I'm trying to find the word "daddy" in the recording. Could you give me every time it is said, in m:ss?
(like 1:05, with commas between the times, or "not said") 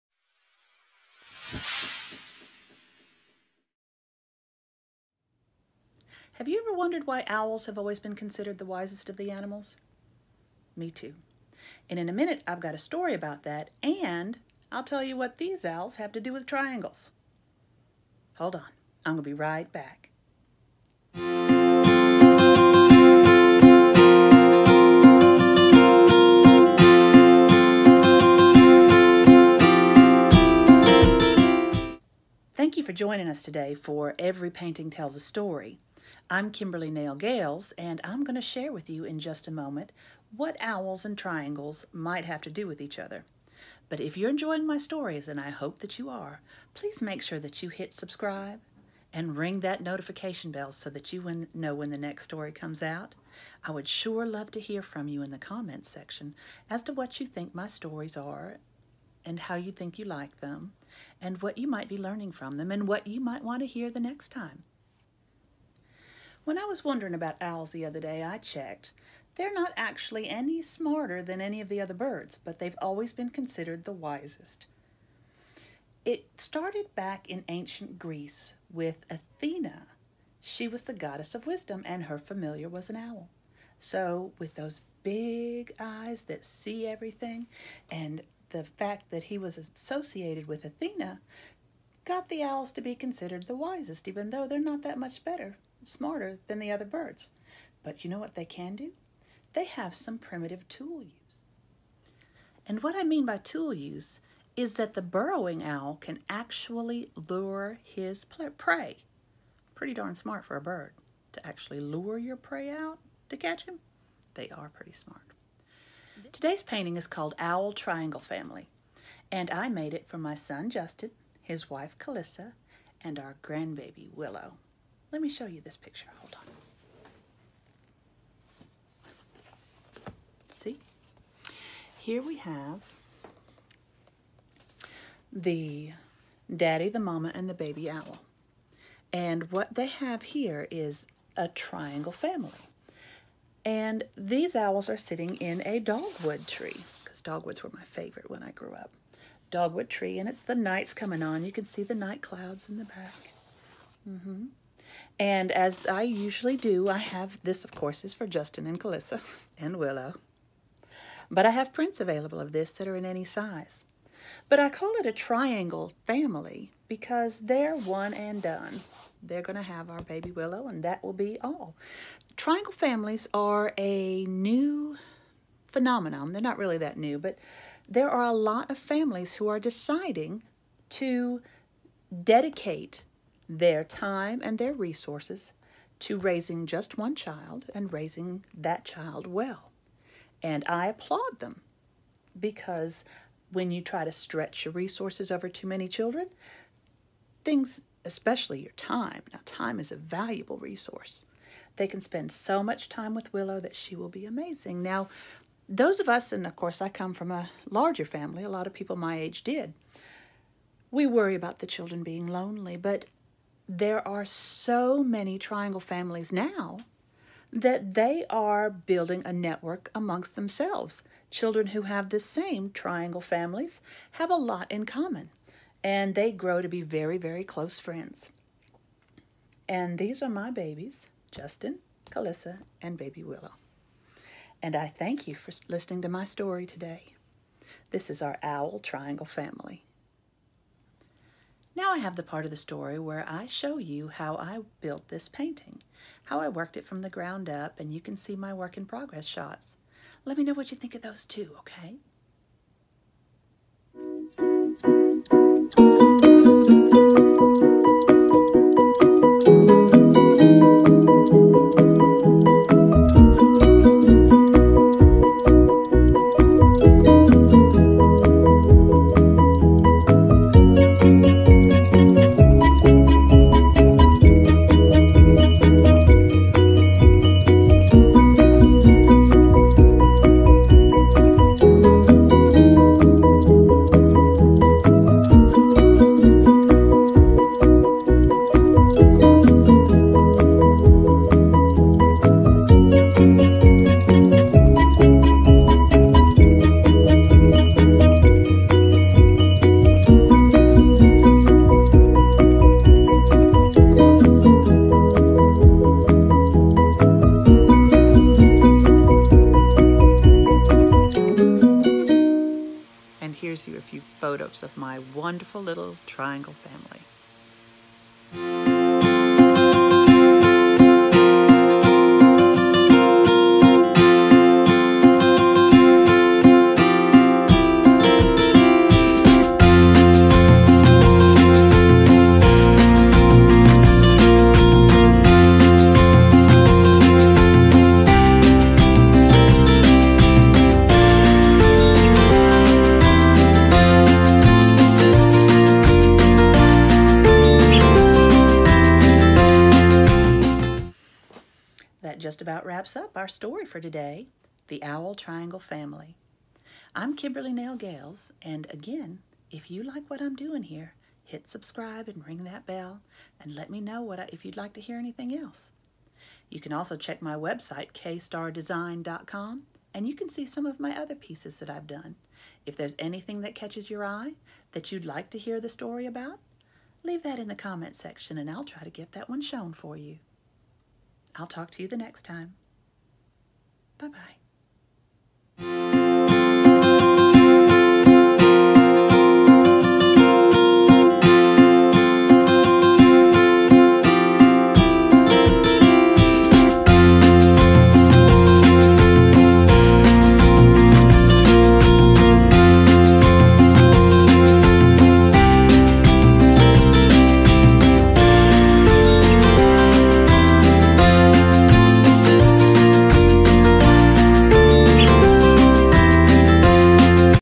2:16.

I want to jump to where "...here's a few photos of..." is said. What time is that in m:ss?
5:13.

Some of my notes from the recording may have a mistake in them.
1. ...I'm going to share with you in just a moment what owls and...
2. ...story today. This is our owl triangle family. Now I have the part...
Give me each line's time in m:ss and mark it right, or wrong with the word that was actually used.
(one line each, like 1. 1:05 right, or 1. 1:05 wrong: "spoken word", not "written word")
1. 0:38 right
2. 3:56 right.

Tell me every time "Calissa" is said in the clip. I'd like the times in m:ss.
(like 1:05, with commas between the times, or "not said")
2:01, 2:38, 3:52.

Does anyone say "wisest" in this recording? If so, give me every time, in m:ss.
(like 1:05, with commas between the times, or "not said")
0:08, 1:13, 1:33.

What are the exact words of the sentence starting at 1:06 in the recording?
When I was wondering about owls the other day, I checked.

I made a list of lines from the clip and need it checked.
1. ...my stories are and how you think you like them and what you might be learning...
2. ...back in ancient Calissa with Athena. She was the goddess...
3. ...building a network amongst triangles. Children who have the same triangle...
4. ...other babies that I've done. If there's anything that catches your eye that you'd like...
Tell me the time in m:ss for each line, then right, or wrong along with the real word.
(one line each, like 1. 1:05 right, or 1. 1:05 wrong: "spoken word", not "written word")
1. 0:57 right
2. 1:16 wrong: "Greece", not "Calissa"
3. 3:38 wrong: "themselves", not "triangles"
4. 6:10 wrong: "pieces", not "babies".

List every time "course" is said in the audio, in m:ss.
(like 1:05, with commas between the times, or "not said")
2:37, 3:26.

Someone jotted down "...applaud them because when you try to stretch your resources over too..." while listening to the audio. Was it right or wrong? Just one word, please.
right.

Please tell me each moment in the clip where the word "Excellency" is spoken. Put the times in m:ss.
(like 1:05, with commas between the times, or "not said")
not said.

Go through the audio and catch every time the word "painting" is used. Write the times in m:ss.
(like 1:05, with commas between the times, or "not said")
0:34, 1:56, 4:05.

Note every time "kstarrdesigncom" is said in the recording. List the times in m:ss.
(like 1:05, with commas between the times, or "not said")
6:07.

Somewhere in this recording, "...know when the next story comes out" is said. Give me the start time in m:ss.
0:51.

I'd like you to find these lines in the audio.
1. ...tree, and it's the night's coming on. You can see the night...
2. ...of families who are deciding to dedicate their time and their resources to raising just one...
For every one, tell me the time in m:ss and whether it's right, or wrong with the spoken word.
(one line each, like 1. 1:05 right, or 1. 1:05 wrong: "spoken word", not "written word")
1. 2:29 right
2. 2:58 right.